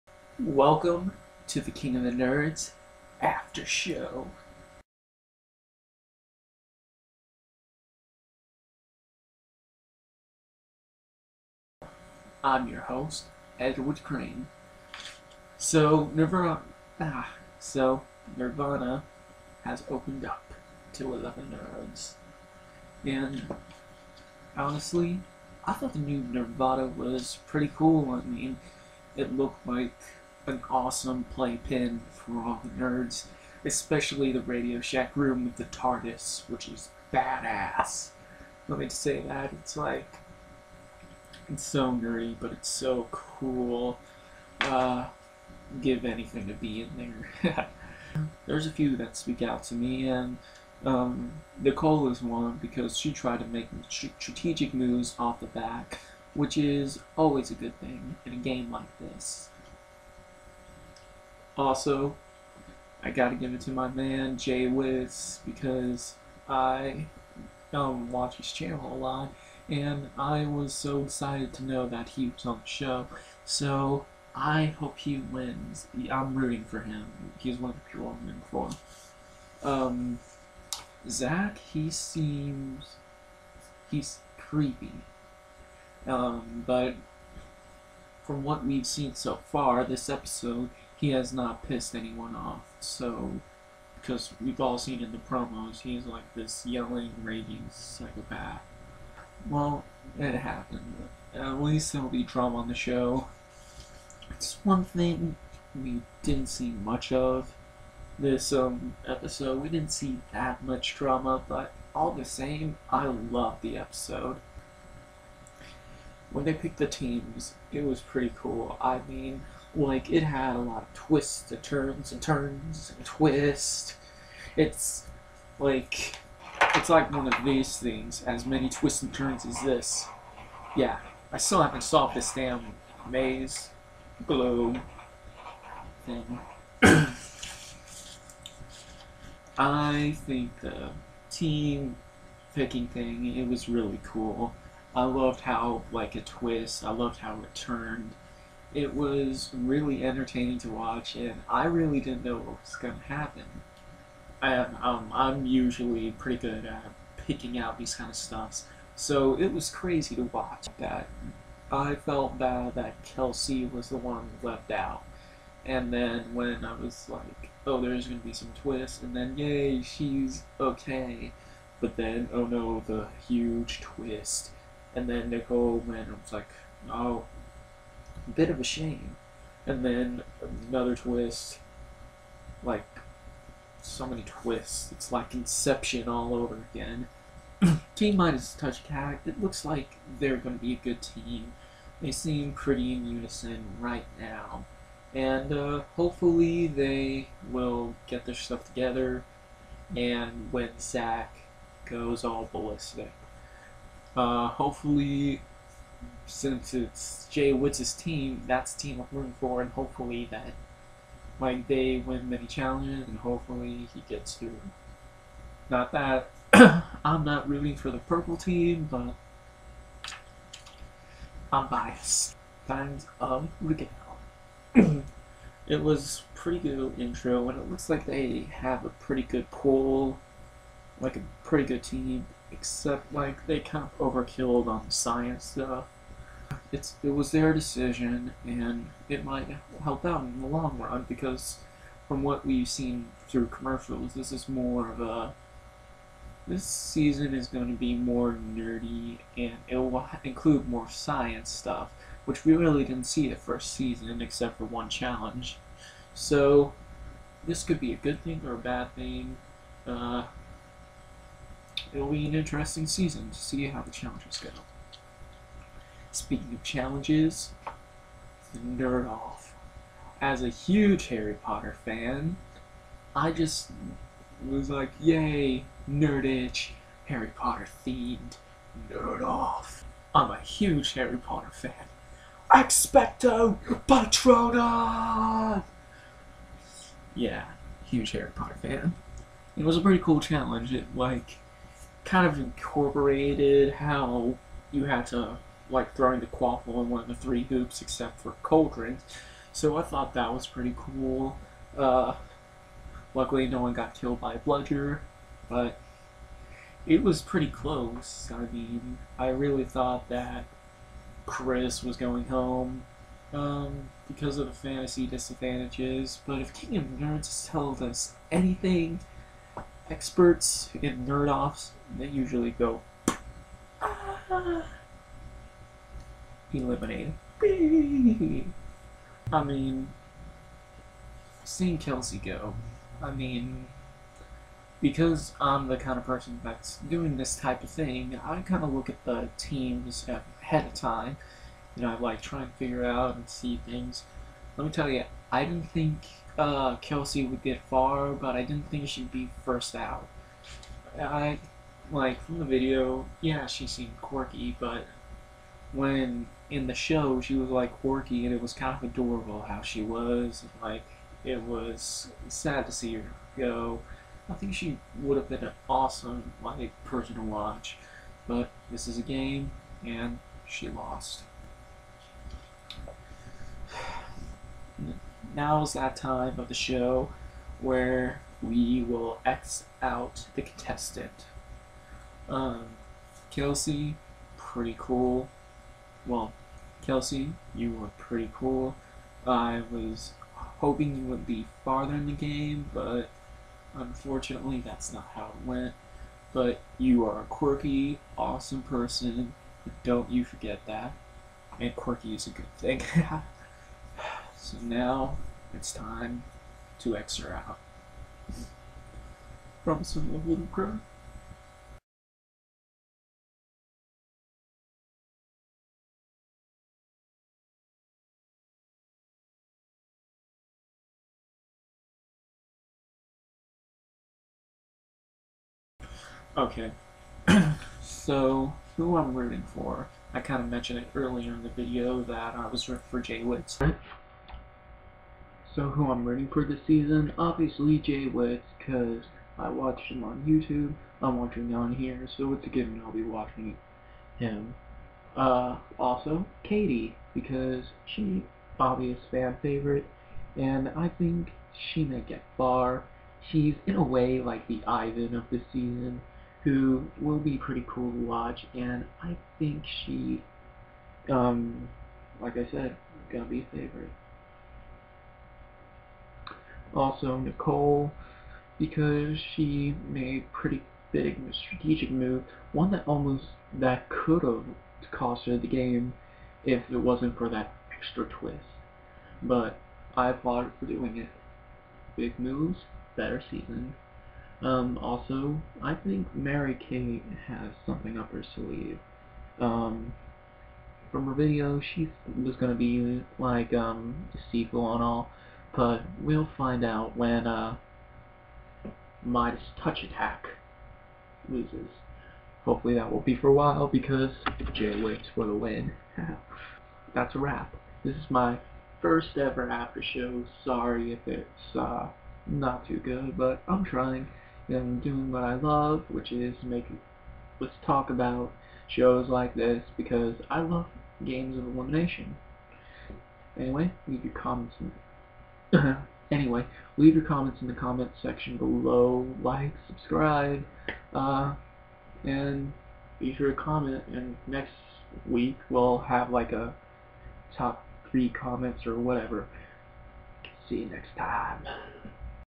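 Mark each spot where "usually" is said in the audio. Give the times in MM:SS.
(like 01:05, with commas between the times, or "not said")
02:35, 05:22.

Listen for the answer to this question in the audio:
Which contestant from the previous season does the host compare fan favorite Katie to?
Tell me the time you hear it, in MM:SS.
07:34.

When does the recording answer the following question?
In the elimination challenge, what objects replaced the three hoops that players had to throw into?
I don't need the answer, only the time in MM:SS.
04:58.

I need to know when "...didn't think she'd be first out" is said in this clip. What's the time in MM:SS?
05:48.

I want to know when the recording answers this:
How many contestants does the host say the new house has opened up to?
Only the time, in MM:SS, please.
00:21.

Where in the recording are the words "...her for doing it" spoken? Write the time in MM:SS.
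08:00.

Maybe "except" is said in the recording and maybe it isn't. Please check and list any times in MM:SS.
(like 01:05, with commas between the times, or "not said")
03:52, 04:14, 04:57.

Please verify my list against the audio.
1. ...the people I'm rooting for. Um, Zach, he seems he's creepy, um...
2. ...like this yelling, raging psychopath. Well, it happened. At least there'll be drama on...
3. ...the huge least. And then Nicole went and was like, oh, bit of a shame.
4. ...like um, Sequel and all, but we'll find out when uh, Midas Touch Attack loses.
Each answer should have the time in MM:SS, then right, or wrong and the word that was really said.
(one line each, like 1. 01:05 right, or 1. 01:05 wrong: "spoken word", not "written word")
1. 01:17 right
2. 01:36 right
3. 02:52 wrong: "twist", not "least"
4. 08:13 right.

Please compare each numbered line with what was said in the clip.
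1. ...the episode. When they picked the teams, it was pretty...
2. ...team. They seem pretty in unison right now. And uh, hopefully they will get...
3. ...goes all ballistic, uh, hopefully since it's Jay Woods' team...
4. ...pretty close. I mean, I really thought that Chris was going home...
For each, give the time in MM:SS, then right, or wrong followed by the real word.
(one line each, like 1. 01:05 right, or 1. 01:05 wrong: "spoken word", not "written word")
1. 01:53 right
2. 03:11 right
3. 03:21 right
4. 05:07 right.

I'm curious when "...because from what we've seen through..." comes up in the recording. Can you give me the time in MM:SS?
04:01.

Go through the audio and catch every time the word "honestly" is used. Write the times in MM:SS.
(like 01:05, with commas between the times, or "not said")
00:24.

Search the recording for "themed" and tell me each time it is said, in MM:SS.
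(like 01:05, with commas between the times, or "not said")
04:37.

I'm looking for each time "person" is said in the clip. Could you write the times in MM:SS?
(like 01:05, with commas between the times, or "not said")
05:36, 06:06, 06:38.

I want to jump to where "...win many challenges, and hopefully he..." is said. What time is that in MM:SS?
03:32.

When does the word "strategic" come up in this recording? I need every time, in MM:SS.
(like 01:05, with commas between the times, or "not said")
00:53, 07:51.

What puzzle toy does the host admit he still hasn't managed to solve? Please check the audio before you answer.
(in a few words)
maze globe.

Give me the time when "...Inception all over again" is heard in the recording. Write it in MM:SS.
03:05.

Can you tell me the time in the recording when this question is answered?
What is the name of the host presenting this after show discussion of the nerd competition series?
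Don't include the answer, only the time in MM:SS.
00:13.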